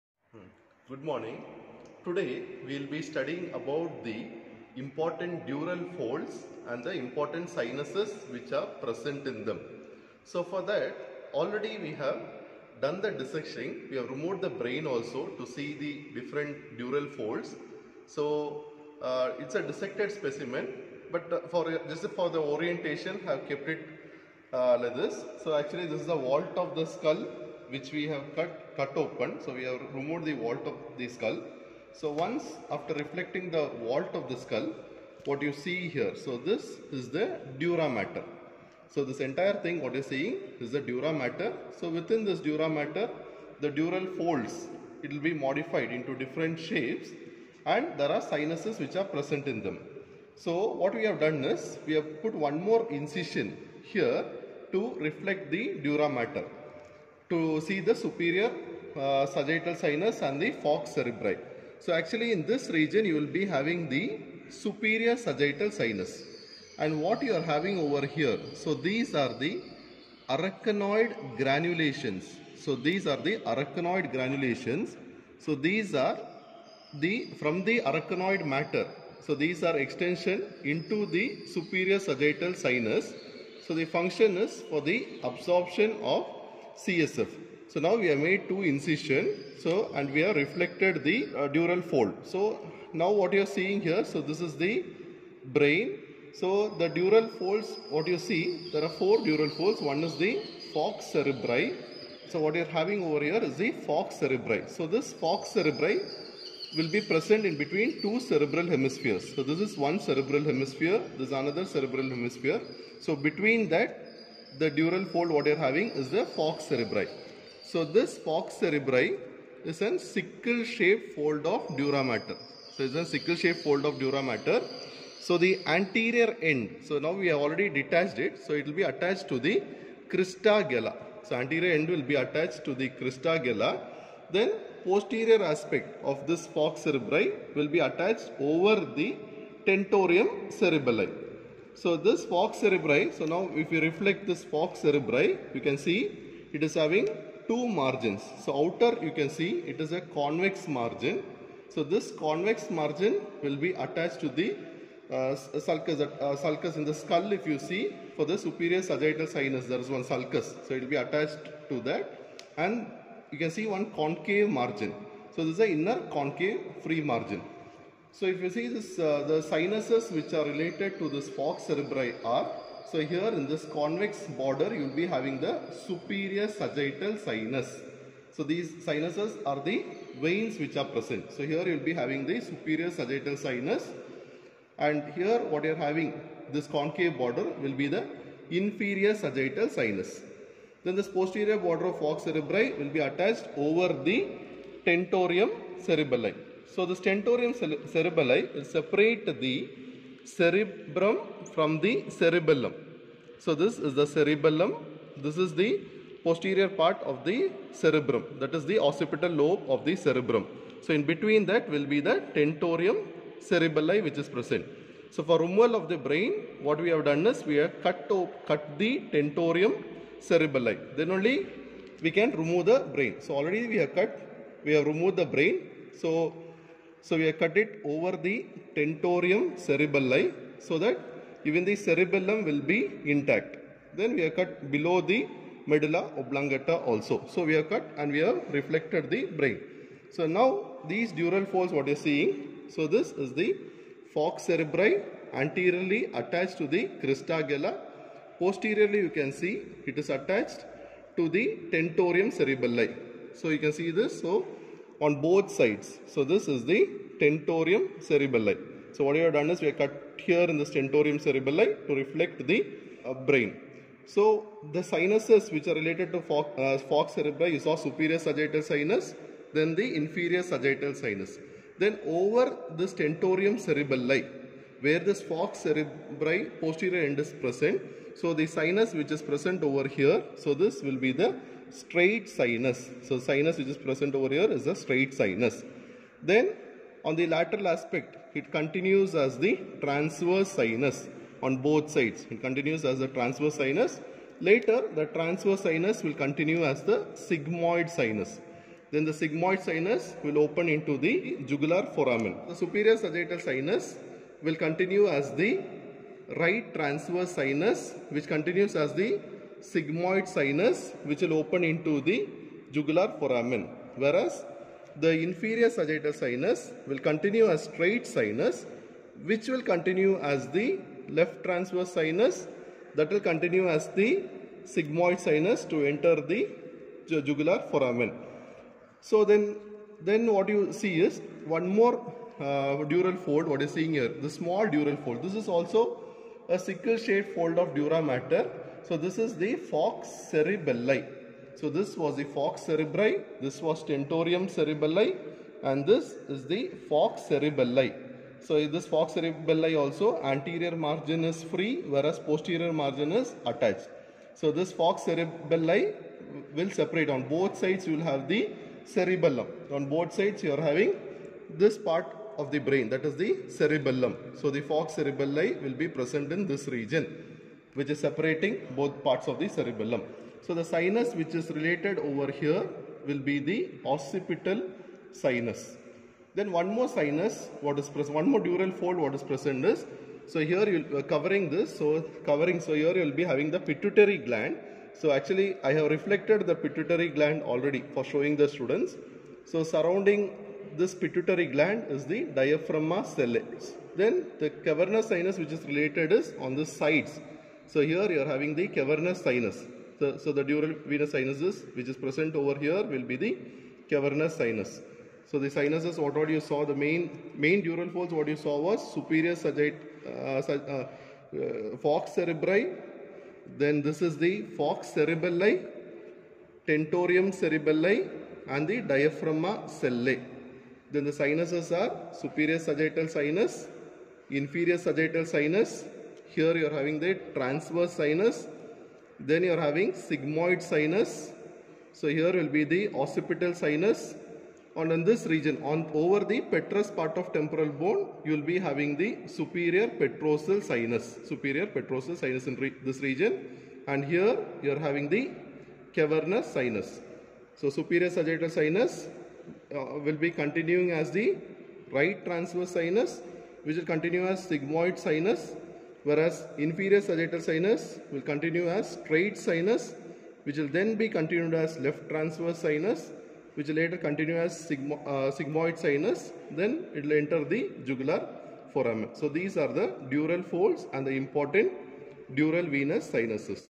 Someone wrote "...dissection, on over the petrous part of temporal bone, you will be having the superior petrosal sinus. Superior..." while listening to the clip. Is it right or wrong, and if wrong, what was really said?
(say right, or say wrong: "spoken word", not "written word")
wrong: "region", not "dissection".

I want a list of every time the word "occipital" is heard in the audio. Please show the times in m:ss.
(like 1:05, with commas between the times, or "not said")
3:28, 6:13, 7:12.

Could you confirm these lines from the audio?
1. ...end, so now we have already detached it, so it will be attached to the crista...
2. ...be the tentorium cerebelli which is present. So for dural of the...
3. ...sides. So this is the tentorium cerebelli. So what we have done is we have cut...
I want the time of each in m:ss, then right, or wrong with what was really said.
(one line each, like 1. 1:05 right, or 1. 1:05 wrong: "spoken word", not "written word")
1. 2:06 right
2. 3:31 wrong: "removal", not "dural"
3. 4:15 right.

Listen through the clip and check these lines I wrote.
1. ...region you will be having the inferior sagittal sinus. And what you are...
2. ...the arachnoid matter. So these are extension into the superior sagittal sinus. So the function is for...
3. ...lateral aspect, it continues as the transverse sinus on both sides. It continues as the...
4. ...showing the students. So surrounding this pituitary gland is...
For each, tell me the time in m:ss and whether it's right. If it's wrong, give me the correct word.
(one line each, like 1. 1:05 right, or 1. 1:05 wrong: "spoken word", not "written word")
1. 1:02 wrong: "superior", not "inferior"
2. 1:17 right
3. 4:47 right
4. 6:28 right.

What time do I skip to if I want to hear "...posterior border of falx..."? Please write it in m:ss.
3:11.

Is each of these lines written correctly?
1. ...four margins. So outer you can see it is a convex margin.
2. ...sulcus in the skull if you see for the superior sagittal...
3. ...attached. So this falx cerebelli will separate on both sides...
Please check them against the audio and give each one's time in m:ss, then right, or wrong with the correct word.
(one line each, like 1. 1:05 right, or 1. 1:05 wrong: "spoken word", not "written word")
1. 2:27 wrong: "two", not "four"
2. 2:36 right
3. 5:53 right.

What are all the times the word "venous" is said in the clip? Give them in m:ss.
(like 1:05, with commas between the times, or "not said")
6:40, 7:52.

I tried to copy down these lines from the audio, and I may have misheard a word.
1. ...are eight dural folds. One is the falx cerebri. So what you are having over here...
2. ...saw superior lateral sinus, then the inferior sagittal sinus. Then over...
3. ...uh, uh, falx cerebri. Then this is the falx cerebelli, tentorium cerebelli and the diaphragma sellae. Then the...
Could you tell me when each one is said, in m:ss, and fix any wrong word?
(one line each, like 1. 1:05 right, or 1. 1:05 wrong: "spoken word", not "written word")
1. 1:38 wrong: "four", not "eight"
2. 4:27 wrong: "sagittal", not "lateral"
3. 6:50 right.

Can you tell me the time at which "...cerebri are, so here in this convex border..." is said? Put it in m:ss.
2:51.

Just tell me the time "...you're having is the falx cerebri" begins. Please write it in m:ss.
1:55.